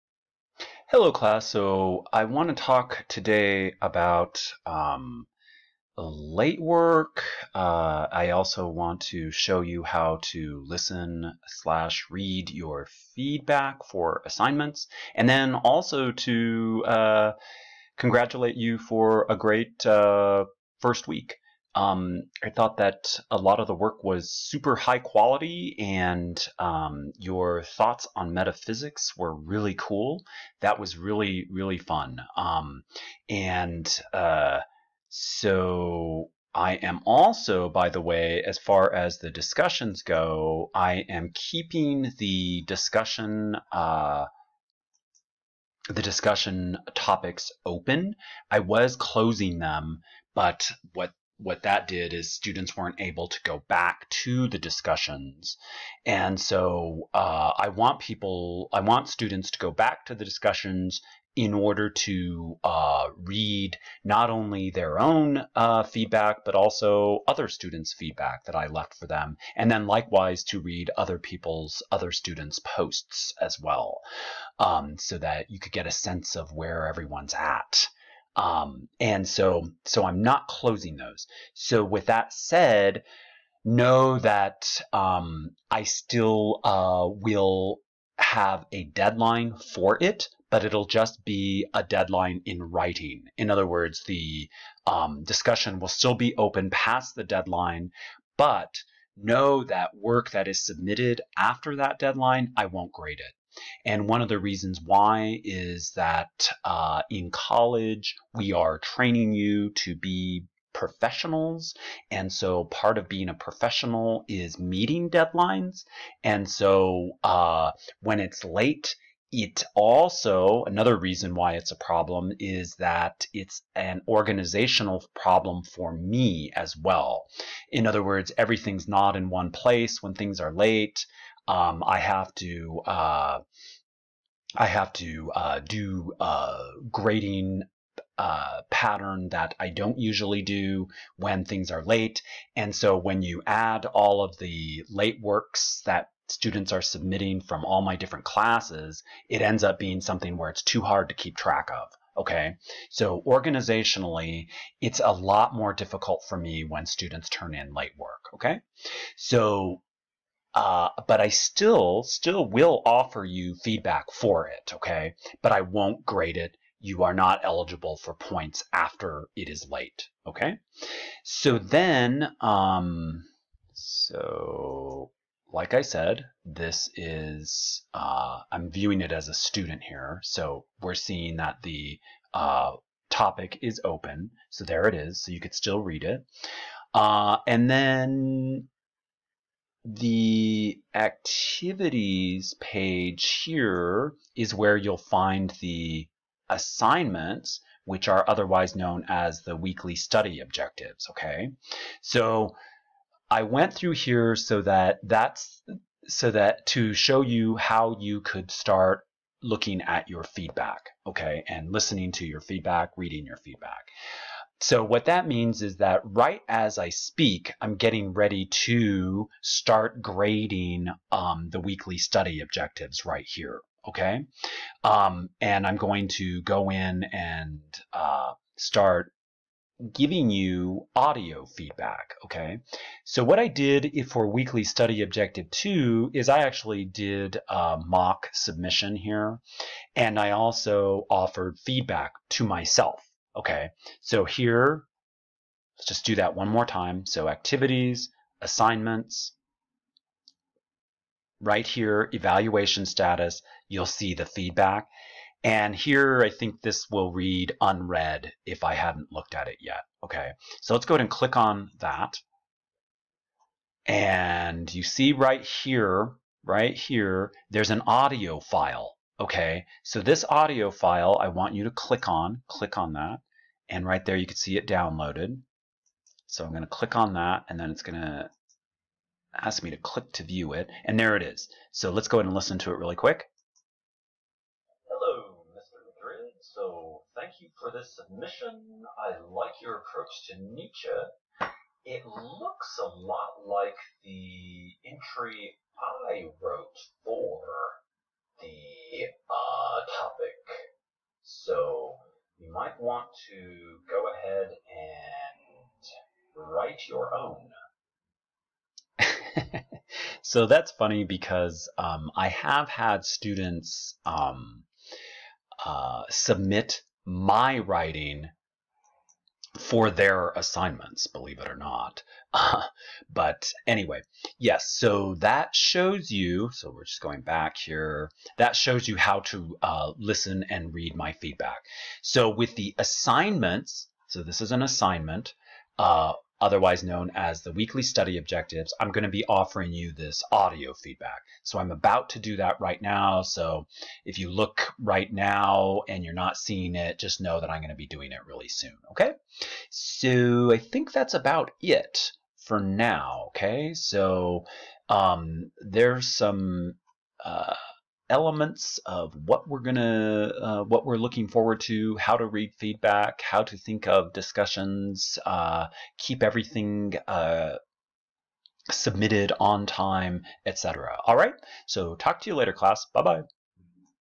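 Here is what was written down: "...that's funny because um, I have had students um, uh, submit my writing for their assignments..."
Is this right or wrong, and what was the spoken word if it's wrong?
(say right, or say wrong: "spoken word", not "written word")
right.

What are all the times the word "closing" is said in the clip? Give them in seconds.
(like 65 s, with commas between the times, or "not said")
48 s, 80 s.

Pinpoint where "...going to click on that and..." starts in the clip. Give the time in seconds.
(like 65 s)
276 s.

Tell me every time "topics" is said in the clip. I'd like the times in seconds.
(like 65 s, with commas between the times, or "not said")
46 s, 183 s.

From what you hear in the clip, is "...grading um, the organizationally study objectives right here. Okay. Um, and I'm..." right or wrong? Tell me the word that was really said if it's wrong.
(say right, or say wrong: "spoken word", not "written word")
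wrong: "weekly", not "organizationally".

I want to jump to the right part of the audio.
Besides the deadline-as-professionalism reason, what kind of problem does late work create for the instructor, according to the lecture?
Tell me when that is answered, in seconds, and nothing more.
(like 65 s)
124 s.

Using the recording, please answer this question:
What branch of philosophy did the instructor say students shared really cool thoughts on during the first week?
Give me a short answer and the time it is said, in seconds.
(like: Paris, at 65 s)
metaphysics, at 28 s.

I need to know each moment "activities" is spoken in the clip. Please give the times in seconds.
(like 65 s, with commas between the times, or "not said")
190 s, 247 s.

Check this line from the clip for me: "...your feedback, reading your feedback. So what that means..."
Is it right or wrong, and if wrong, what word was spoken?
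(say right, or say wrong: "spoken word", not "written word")
right.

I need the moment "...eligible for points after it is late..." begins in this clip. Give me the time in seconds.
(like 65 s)
167 s.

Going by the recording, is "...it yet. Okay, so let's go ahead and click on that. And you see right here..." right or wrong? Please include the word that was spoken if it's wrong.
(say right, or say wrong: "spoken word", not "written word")
right.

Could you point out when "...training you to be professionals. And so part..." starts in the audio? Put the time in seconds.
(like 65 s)
108 s.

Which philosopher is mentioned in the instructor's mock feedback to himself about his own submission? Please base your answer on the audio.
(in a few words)
Nietzsche.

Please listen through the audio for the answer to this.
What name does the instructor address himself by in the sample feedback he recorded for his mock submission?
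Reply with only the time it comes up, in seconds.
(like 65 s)
285 s.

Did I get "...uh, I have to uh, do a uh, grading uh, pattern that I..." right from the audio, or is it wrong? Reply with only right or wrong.
right.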